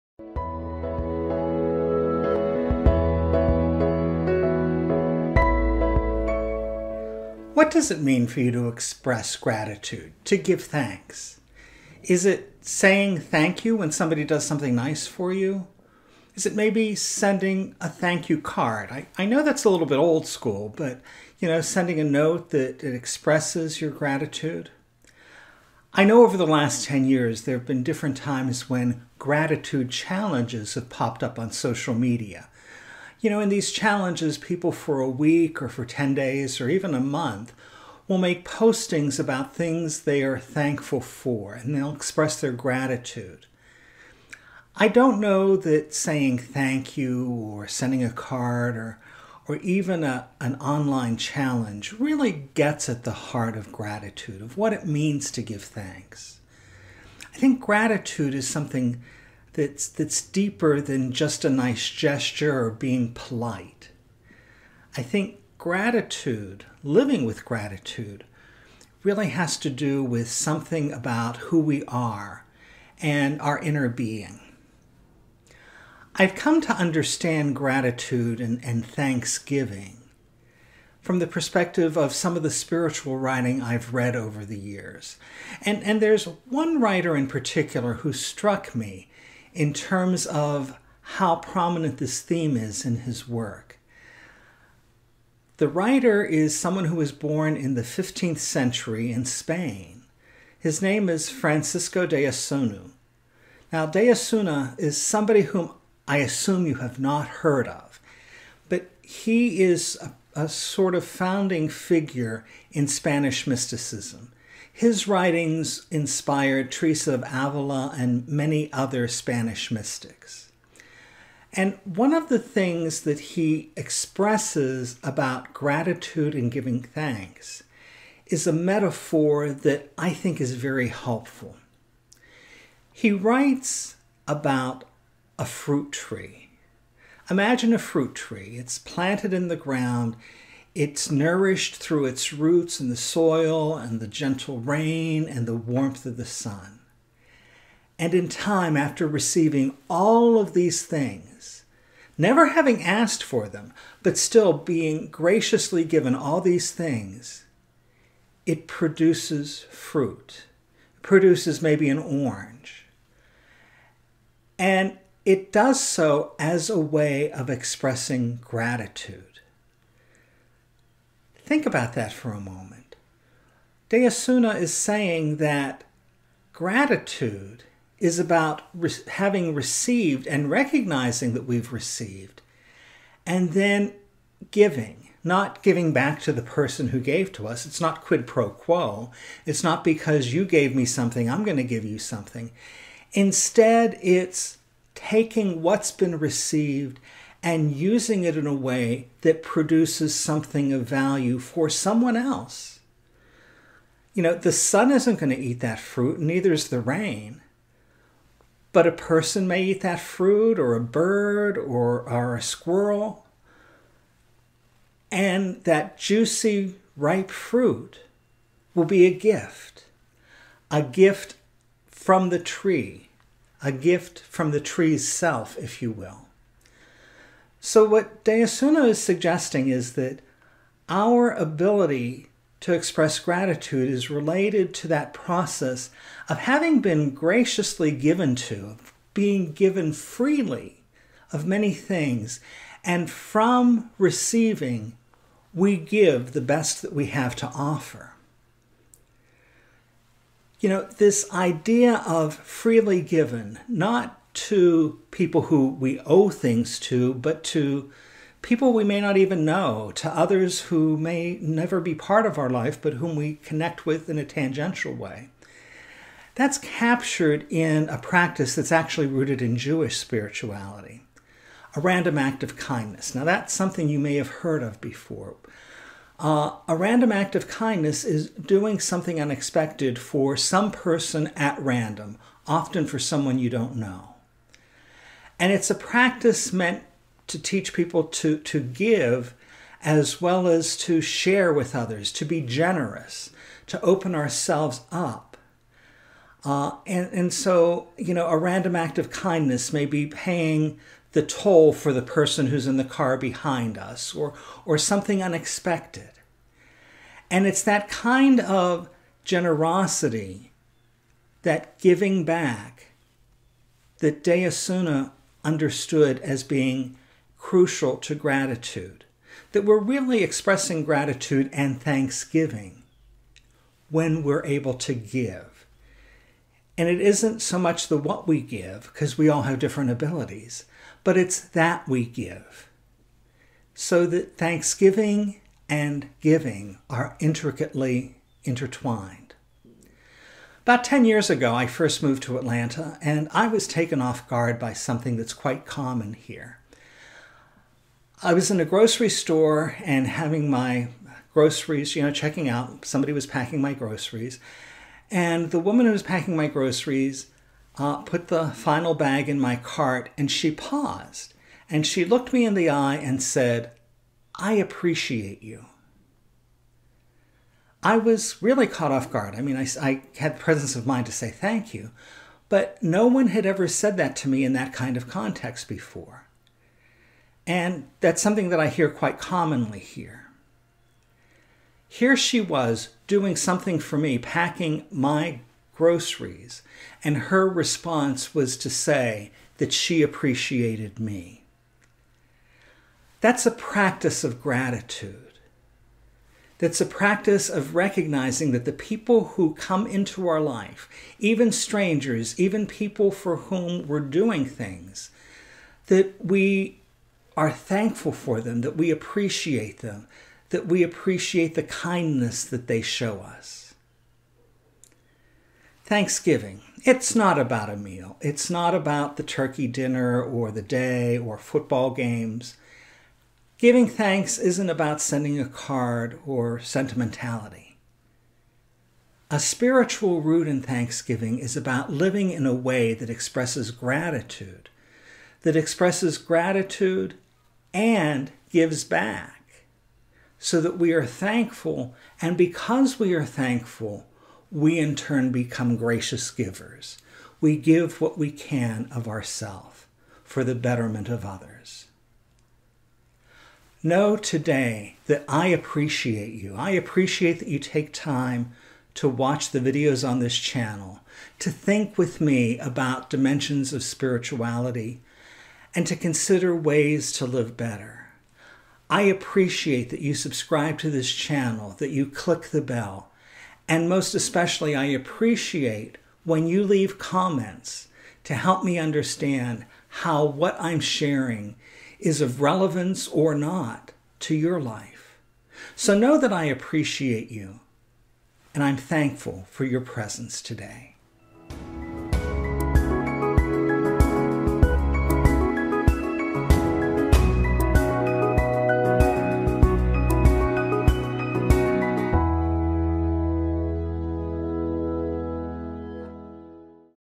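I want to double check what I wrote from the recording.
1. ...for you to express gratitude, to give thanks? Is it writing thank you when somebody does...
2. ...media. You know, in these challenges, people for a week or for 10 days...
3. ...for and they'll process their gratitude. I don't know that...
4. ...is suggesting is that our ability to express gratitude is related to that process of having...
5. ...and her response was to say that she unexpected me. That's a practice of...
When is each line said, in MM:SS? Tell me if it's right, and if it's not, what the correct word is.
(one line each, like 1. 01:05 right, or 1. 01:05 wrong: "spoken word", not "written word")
1. 00:08 wrong: "saying", not "writing"
2. 00:31 right
3. 00:41 wrong: "express", not "process"
4. 03:48 right
5. 06:27 wrong: "appreciated", not "unexpected".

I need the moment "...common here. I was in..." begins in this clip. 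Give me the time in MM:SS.
05:45.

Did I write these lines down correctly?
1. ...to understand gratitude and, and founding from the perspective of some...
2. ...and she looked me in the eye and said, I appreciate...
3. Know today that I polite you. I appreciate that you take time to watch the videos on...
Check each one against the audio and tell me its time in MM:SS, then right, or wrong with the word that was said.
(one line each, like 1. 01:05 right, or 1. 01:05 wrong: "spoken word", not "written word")
1. 01:16 wrong: "thanksgiving", not "founding"
2. 06:01 right
3. 07:33 wrong: "appreciate", not "polite".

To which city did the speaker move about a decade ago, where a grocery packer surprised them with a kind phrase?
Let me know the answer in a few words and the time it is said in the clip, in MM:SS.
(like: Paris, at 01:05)
Atlanta, at 05:42.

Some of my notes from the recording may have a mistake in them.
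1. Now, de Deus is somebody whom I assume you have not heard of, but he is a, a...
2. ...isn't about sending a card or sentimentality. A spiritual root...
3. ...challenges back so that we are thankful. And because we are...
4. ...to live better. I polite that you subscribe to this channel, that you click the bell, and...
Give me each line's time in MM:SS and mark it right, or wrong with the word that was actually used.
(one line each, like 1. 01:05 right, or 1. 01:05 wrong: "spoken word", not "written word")
1. 01:43 wrong: "Osuna", not "Deus"
2. 07:04 right
3. 07:18 wrong: "gives", not "challenges"
4. 07:47 wrong: "appreciate", not "polite".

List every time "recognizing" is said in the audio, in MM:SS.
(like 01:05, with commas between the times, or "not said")
03:00, 06:37.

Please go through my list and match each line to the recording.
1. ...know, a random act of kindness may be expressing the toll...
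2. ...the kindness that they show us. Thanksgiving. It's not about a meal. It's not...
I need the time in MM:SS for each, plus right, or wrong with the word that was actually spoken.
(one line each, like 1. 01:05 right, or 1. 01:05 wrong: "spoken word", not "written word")
1. 04:58 wrong: "paying", not "expressing"
2. 06:51 right.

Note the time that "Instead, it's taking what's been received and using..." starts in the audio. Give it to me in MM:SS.
03:13.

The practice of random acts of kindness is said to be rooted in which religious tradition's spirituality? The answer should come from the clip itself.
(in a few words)
Jewish.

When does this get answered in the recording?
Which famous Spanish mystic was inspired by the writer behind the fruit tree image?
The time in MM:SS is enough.
01:56.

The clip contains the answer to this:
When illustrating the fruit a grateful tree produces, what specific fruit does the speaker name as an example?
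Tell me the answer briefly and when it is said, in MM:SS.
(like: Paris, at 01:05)
orange, at 02:41.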